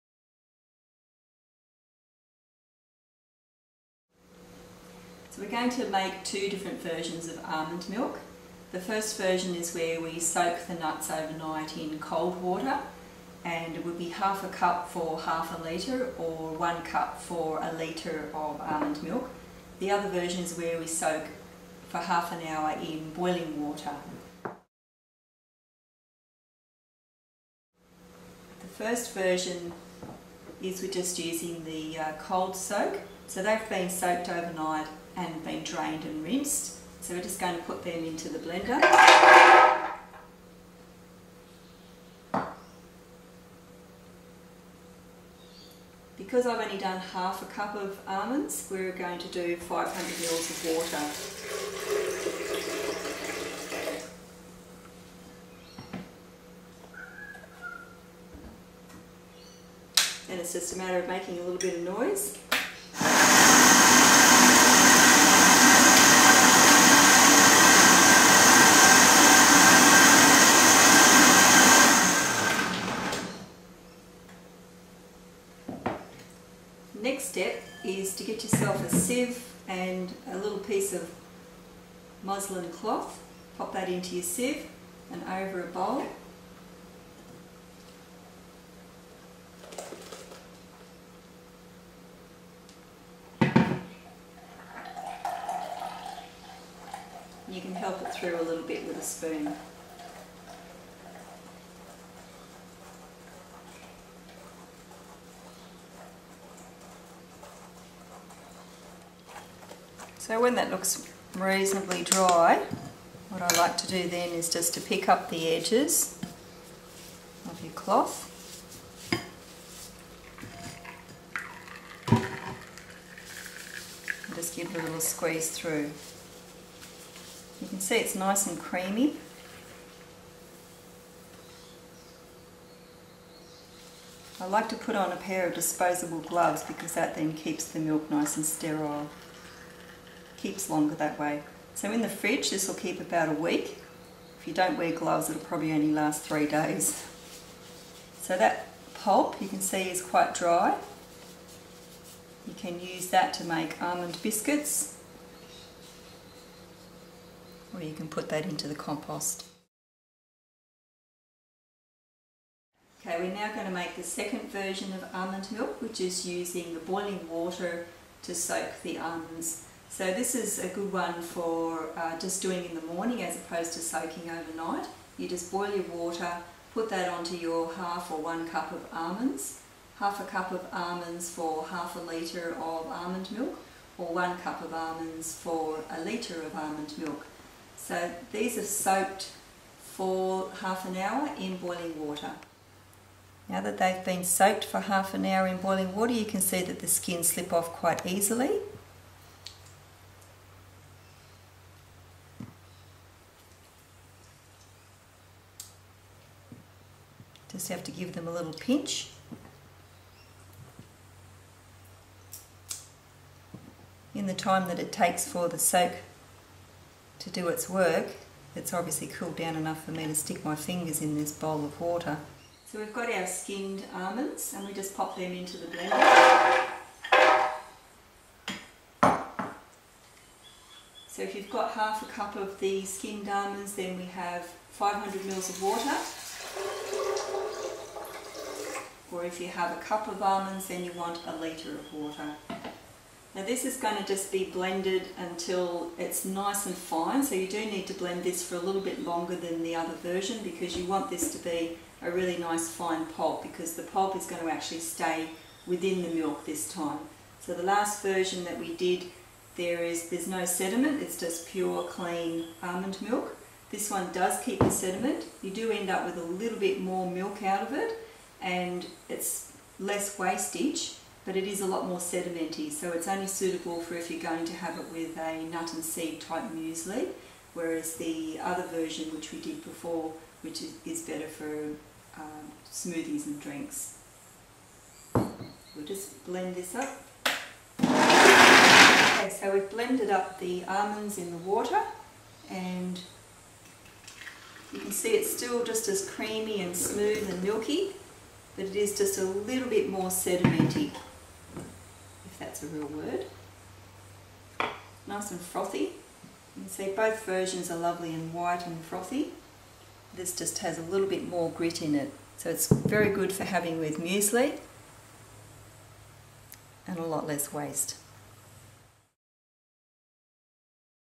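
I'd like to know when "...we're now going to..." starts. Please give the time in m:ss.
2:43.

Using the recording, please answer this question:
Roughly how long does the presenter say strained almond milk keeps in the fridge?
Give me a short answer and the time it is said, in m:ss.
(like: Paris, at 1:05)
about a week, at 2:22.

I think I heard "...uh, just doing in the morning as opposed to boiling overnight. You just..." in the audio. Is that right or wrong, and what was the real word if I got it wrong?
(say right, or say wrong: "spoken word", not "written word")
wrong: "soaking", not "boiling".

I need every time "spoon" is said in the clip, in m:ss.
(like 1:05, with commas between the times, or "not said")
1:39.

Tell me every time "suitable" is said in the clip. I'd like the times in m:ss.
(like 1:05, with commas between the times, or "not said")
4:33.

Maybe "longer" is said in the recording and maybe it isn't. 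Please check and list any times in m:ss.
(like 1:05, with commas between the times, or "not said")
2:20, 4:09.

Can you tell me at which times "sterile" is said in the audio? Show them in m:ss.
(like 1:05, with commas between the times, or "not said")
2:18.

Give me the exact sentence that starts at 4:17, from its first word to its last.
So the last version that we did there is there's no sediment it's just pure clean almond milk.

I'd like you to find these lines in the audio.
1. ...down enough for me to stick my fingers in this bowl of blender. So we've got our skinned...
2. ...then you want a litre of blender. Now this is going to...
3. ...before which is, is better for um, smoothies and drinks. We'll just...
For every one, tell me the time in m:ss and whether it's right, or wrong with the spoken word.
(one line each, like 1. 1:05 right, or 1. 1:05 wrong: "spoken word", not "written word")
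1. 3:39 wrong: "water", not "blender"
2. 4:00 wrong: "water", not "blender"
3. 4:39 right.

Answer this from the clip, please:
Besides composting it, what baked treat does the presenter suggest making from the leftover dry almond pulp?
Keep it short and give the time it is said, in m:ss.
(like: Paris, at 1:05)
almond biscuits, at 2:33.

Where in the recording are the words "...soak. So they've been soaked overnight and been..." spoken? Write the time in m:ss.
0:32.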